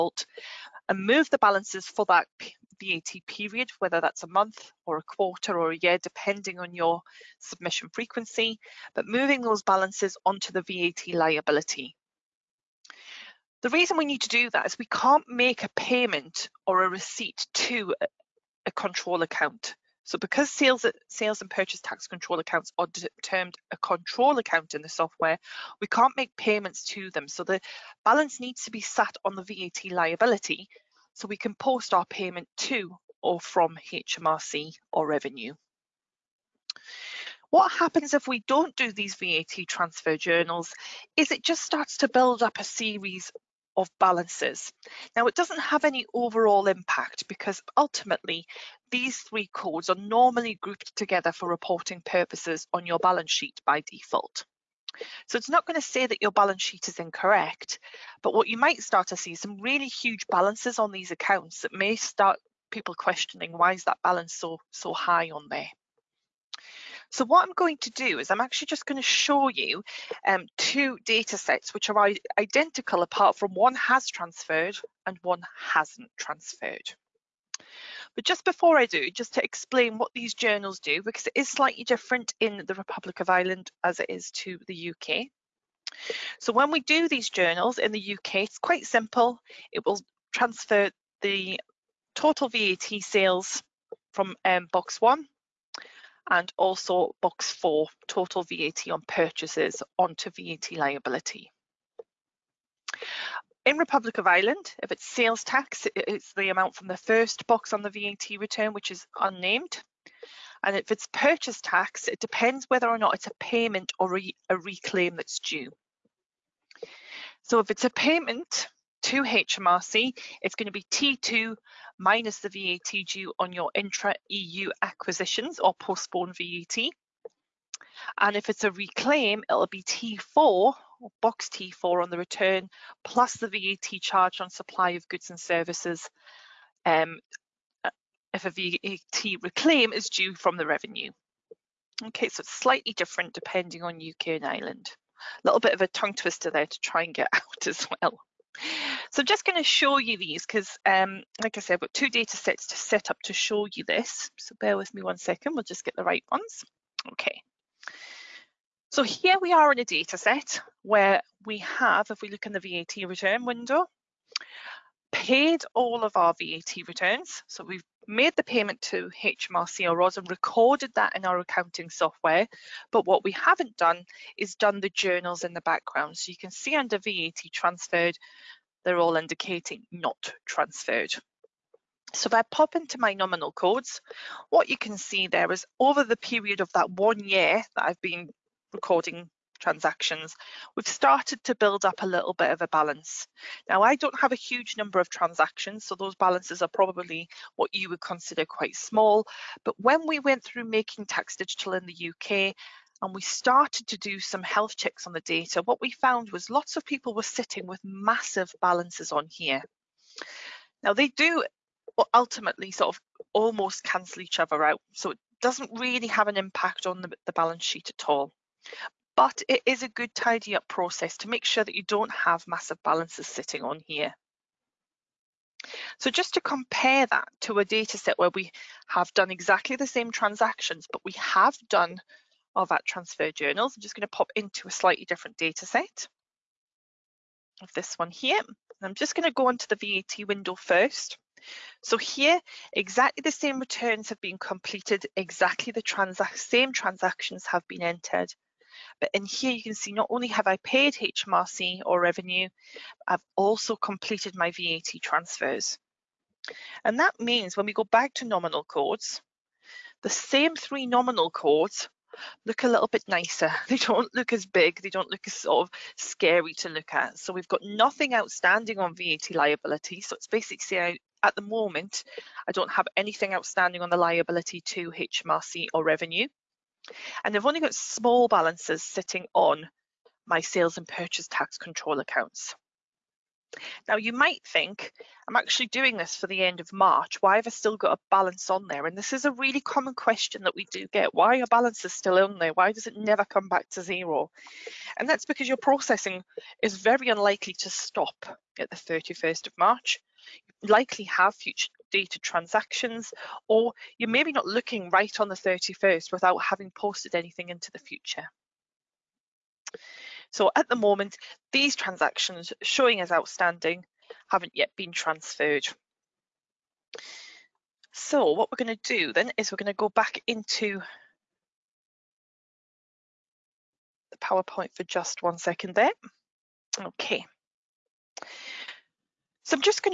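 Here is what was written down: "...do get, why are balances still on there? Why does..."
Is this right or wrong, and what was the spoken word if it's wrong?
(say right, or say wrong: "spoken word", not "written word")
right.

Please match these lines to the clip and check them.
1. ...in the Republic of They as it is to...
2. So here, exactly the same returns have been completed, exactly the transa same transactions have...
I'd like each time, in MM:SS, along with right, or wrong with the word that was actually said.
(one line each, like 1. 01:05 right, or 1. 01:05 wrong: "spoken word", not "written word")
1. 01:22 wrong: "Ireland", not "They"
2. 04:01 right.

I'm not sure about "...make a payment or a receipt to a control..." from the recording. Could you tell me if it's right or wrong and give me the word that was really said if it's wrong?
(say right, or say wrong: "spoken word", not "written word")
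right.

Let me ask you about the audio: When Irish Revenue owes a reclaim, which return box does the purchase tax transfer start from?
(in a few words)
T4.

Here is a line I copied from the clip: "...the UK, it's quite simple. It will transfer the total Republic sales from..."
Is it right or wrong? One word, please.
wrong.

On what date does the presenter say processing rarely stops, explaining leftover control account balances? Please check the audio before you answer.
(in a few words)
31st of March.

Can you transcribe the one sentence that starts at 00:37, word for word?
What happens if we don't do these VAT transfer journals is it just starts to build up a series of balances.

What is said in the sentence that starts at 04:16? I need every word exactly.
And that means when we go back to nominal codes, the same three nominal codes look a little bit nicer.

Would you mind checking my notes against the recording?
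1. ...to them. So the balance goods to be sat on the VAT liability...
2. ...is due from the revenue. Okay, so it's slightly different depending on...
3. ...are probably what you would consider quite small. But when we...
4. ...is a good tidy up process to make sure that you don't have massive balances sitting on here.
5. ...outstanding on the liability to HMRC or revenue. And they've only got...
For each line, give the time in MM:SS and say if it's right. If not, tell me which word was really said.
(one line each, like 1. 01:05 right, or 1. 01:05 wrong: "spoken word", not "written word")
1. 00:26 wrong: "needs", not "goods"
2. 02:19 right
3. 03:16 right
4. 03:39 right
5. 04:33 right.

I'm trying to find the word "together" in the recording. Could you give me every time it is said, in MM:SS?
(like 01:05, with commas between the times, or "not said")
00:50.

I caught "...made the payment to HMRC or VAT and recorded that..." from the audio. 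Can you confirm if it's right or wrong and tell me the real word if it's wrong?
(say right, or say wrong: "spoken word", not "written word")
wrong: "ROS", not "VAT".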